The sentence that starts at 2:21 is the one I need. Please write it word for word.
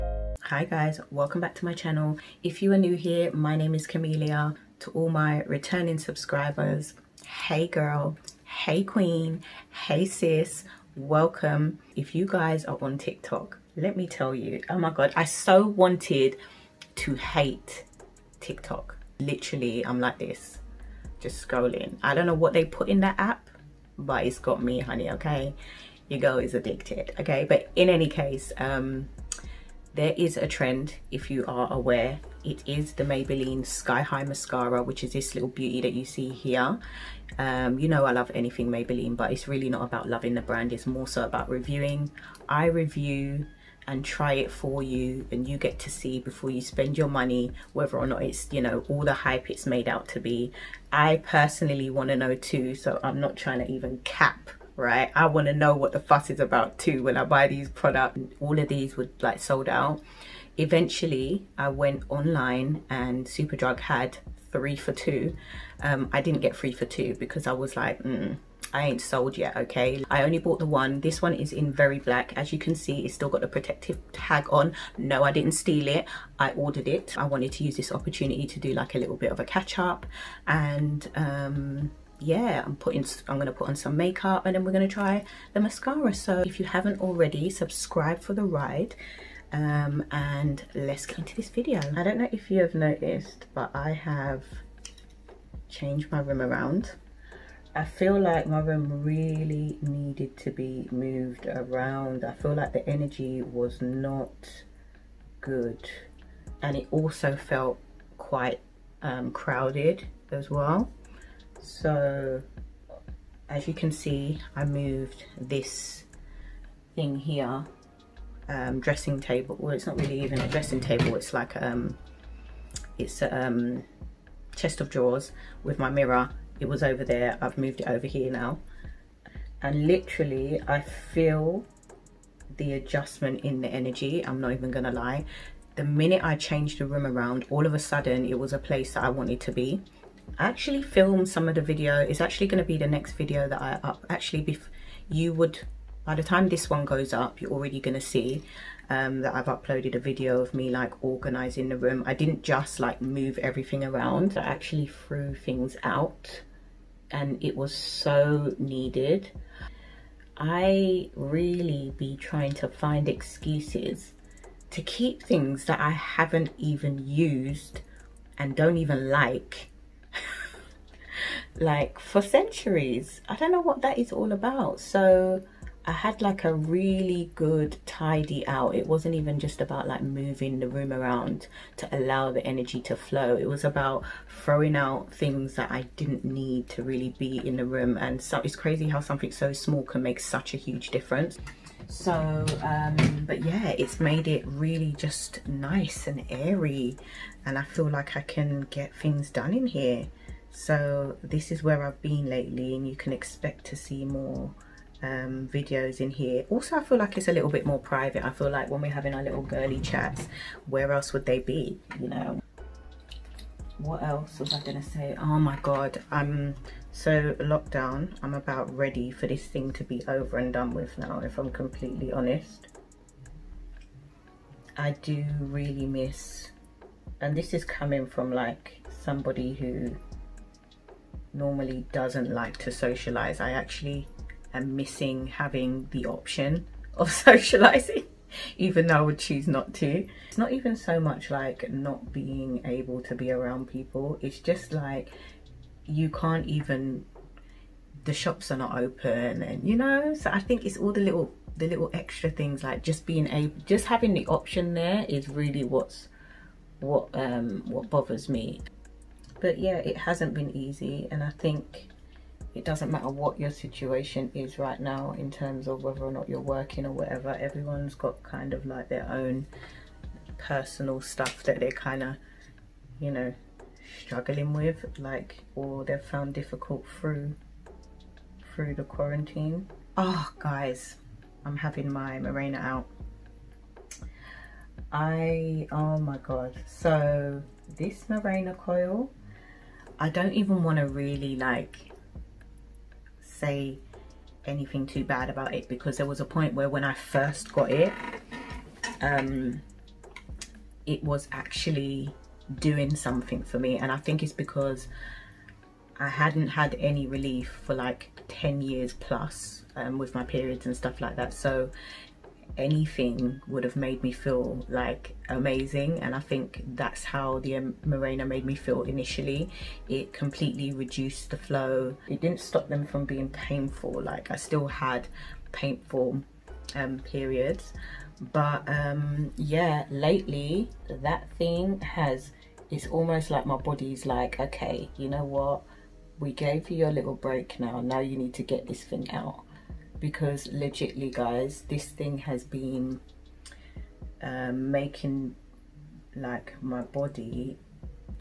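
It's actually going to be the next video that I up.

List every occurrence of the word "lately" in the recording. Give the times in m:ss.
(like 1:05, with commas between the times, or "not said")
3:22, 5:29.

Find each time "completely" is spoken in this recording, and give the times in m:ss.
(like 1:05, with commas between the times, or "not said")
3:41, 5:20.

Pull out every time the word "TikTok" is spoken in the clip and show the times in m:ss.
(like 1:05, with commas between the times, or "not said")
0:12, 0:18.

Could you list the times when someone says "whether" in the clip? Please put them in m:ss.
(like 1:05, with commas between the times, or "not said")
0:47, 4:25.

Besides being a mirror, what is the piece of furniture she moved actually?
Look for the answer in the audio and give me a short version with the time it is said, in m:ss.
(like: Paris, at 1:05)
Chest of drawers, at 2:04.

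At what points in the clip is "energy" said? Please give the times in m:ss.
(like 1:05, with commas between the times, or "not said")
1:42, 2:13, 3:02.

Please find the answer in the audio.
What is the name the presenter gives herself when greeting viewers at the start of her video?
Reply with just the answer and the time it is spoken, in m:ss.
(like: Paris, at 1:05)
Carmelia, at 0:03.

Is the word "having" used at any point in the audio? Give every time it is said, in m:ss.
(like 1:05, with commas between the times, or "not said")
3:28, 3:55, 4:13, 4:41.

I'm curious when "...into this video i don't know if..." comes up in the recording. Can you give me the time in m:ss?
1:31.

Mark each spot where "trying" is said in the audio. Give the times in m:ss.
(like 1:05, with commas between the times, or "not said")
0:53, 2:42.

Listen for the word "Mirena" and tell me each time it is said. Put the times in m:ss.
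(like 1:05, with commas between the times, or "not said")
4:42, 4:48, 5:17.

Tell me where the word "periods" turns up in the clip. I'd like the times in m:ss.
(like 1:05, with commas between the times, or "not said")
5:10, 5:26.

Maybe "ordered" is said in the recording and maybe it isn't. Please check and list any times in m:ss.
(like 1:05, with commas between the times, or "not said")
1:16.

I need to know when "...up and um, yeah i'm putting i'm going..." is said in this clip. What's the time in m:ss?
1:19.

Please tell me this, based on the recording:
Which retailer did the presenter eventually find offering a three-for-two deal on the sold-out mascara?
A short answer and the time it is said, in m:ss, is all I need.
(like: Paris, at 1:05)
Superdrug, at 1:03.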